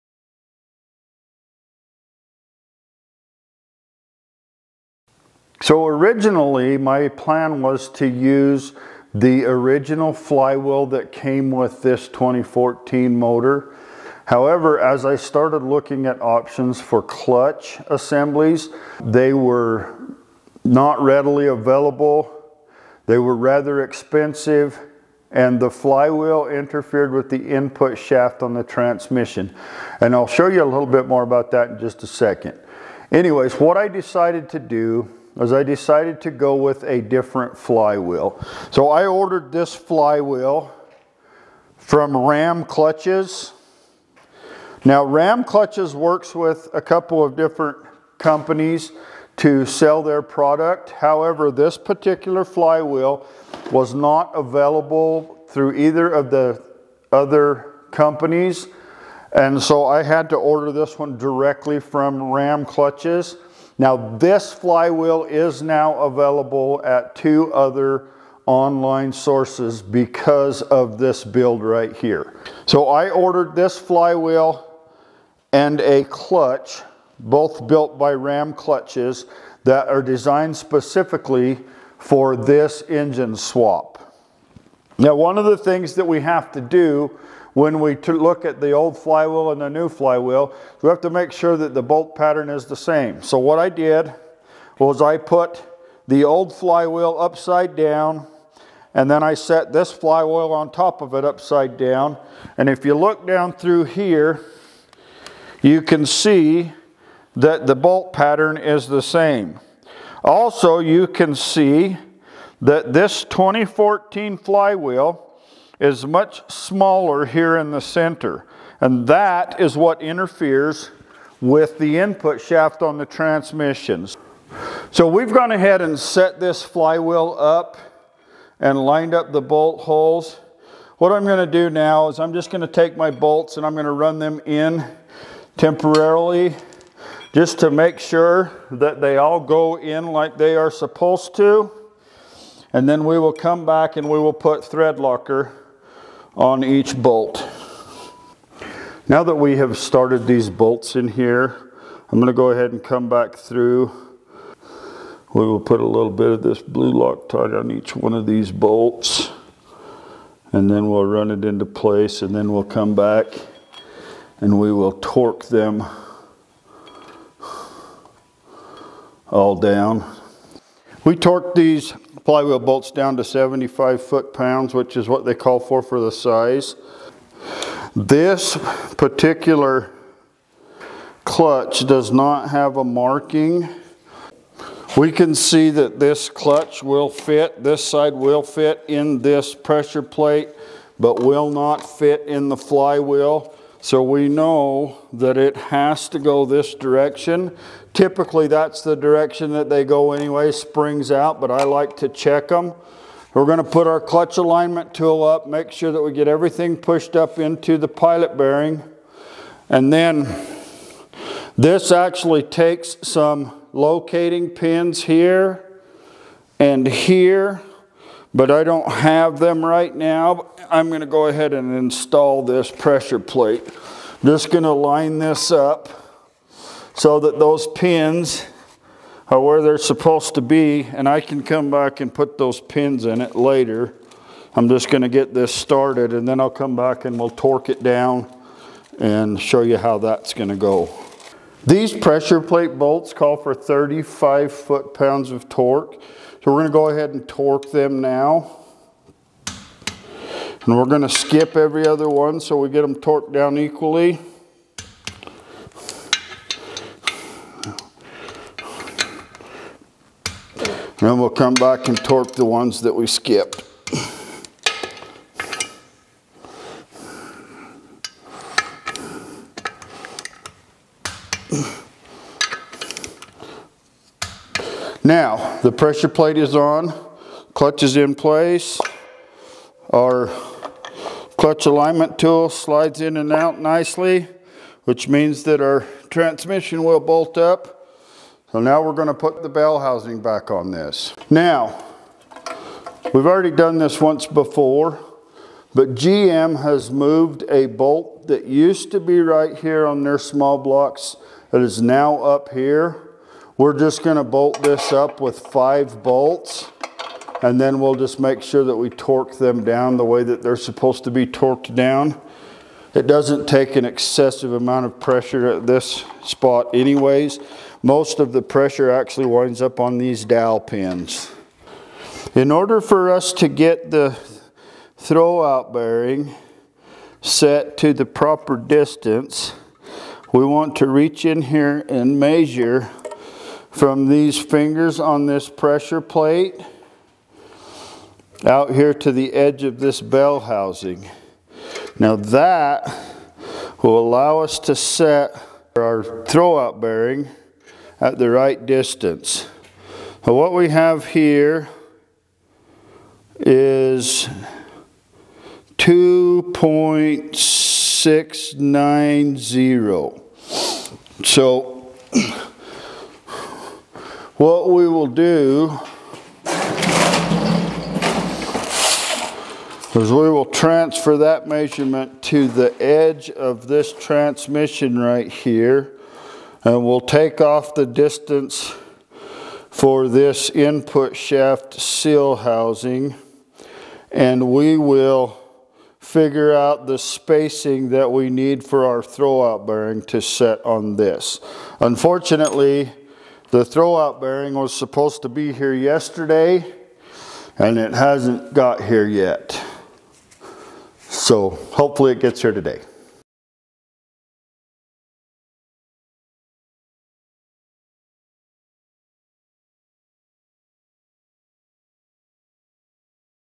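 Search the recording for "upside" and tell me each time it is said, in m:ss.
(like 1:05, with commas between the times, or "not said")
1:37, 1:41.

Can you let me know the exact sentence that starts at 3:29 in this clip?
And then this actually takes some locating pins here and here but I don't have them right now.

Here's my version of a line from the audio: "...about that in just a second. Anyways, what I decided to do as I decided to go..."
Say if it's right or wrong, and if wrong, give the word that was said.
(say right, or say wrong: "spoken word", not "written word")
right.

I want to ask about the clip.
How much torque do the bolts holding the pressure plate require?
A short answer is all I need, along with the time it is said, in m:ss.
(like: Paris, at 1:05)
35 foot-pounds, at 4:03.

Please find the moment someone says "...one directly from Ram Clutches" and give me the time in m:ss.
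1:00.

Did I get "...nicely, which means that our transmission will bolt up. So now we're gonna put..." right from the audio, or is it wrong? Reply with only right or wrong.
right.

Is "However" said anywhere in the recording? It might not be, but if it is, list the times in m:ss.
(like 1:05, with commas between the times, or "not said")
0:14, 0:50.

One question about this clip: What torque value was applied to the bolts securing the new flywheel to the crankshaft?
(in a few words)
75 foot-pounds.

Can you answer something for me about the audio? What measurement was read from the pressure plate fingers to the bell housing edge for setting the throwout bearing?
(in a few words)
2.6690.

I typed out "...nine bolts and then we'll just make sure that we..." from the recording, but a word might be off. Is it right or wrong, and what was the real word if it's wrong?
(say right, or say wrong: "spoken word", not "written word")
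wrong: "five", not "nine".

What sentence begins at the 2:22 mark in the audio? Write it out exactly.
And then we will come back and we will put thread locker on each bolt.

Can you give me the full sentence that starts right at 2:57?
This particular clutch does not have a marking.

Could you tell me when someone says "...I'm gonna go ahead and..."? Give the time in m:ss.
2:32.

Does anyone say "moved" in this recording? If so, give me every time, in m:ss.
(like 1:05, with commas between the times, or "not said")
4:56.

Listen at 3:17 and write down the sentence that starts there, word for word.
Typically, that's the direction that they go anyway, springs out, but I like to check them.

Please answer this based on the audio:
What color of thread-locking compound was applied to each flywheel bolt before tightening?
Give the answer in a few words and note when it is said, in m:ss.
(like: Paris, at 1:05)
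Blue, at 2:36.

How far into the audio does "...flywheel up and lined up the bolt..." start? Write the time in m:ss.
2:06.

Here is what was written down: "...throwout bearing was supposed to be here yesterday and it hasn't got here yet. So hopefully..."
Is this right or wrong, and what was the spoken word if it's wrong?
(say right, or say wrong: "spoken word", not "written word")
right.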